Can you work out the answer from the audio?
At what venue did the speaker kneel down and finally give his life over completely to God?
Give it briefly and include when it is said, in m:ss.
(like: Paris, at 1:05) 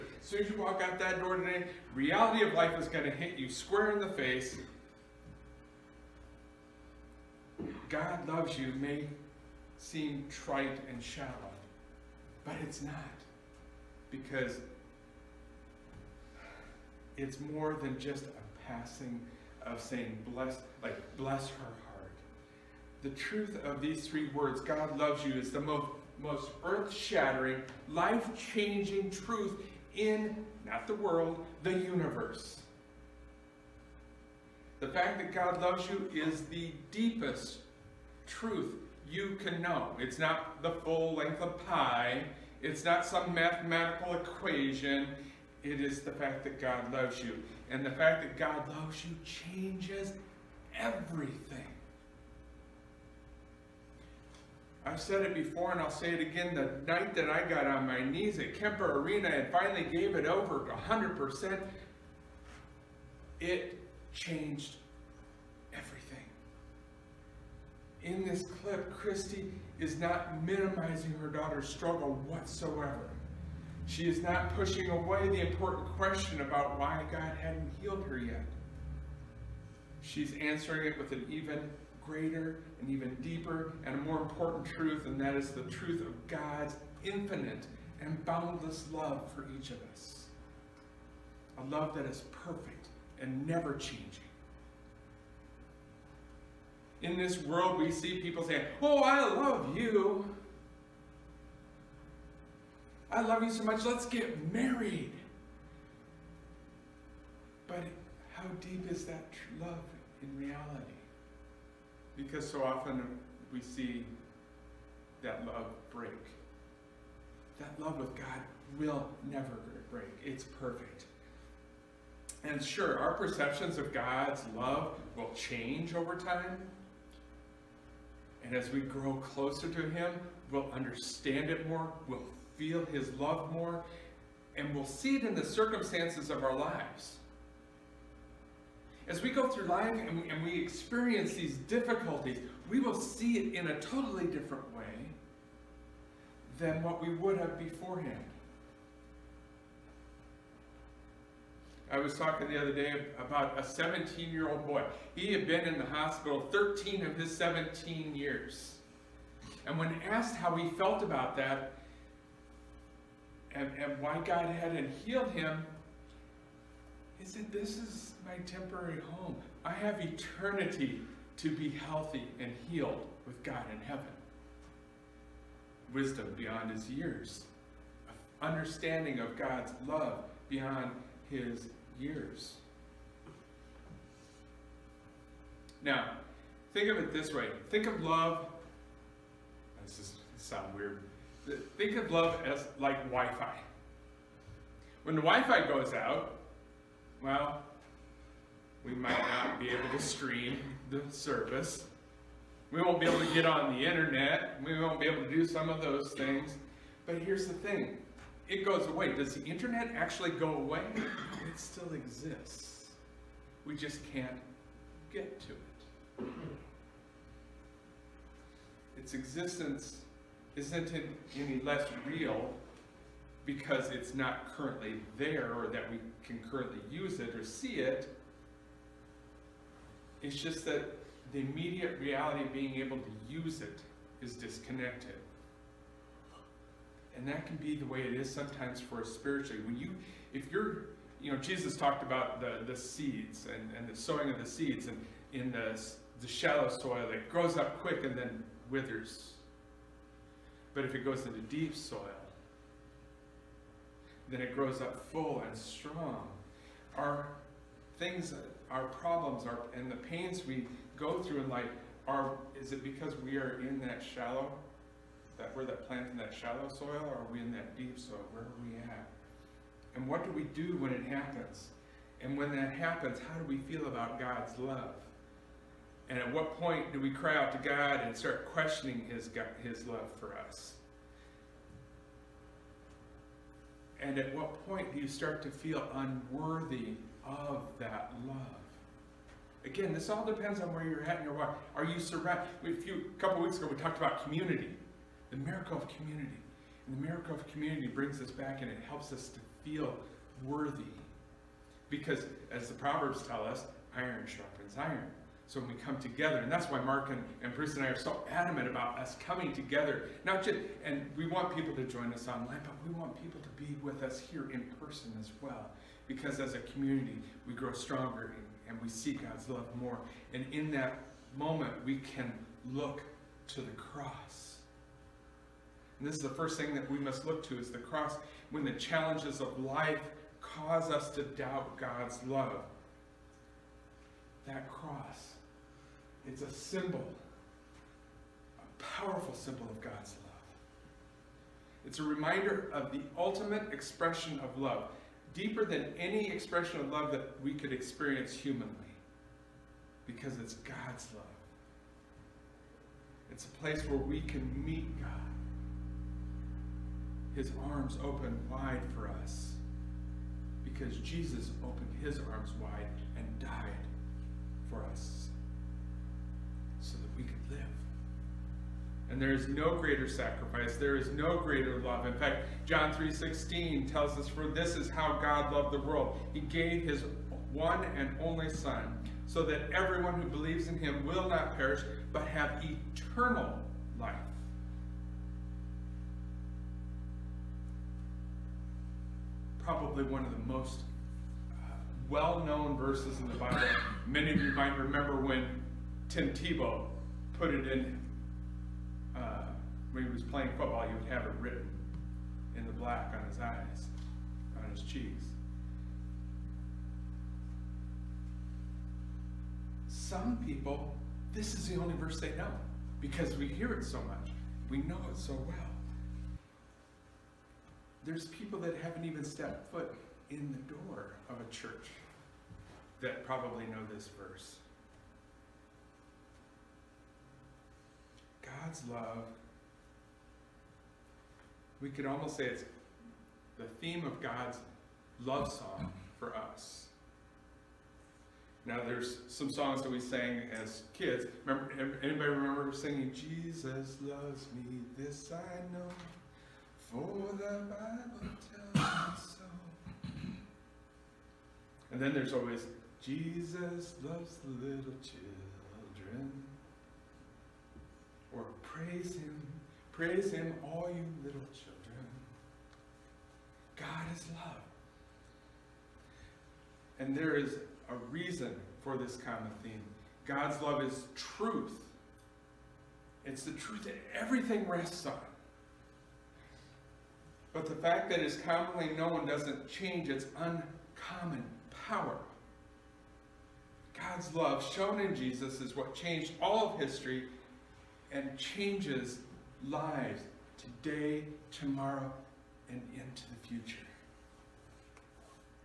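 Kemper Arena, at 0:58.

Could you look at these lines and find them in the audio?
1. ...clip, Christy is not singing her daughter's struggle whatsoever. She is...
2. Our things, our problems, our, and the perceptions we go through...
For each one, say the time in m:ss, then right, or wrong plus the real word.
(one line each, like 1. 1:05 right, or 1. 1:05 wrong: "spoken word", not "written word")
1. 1:08 wrong: "minimizing", not "singing"
2. 4:16 wrong: "pains", not "perceptions".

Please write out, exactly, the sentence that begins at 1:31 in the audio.
A love that is perfect and never changing.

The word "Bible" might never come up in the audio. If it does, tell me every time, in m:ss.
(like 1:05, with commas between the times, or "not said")
6:33, 7:27.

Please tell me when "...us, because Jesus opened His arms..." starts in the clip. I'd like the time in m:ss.
5:59.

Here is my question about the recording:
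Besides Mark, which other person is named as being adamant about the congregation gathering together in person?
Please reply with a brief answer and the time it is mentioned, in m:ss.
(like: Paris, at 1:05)
Bruce, at 5:07.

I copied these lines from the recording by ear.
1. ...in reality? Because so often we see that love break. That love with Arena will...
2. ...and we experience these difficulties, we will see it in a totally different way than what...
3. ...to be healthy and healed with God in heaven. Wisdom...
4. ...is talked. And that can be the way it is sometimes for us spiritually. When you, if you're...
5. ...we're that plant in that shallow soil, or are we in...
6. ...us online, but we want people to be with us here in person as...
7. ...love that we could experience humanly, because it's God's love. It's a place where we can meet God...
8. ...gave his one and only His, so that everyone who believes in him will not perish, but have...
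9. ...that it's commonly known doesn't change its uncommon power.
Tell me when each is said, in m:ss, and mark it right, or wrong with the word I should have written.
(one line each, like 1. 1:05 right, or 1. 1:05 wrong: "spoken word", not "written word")
1. 1:50 wrong: "God", not "Arena"
2. 2:20 right
3. 2:51 right
4. 3:54 wrong: "disconnected", not "talked"
5. 4:25 right
6. 5:12 right
7. 5:46 right
8. 6:16 wrong: "Son", not "His"
9. 7:58 right.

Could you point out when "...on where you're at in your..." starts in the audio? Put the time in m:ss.
4:50.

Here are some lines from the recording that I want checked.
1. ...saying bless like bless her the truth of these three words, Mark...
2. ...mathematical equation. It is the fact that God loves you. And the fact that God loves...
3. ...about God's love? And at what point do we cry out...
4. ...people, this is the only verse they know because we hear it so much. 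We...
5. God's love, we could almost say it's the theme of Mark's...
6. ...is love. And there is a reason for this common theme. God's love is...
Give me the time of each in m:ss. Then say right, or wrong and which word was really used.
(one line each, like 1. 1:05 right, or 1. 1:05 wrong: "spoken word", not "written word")
1. 0:19 wrong: "God", not "Mark"
2. 0:43 right
3. 4:33 right
4. 6:50 right
5. 7:08 wrong: "God", not "Mark"
6. 7:44 right.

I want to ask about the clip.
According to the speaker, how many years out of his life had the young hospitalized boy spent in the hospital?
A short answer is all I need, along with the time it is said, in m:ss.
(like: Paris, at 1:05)
13, at 2:36.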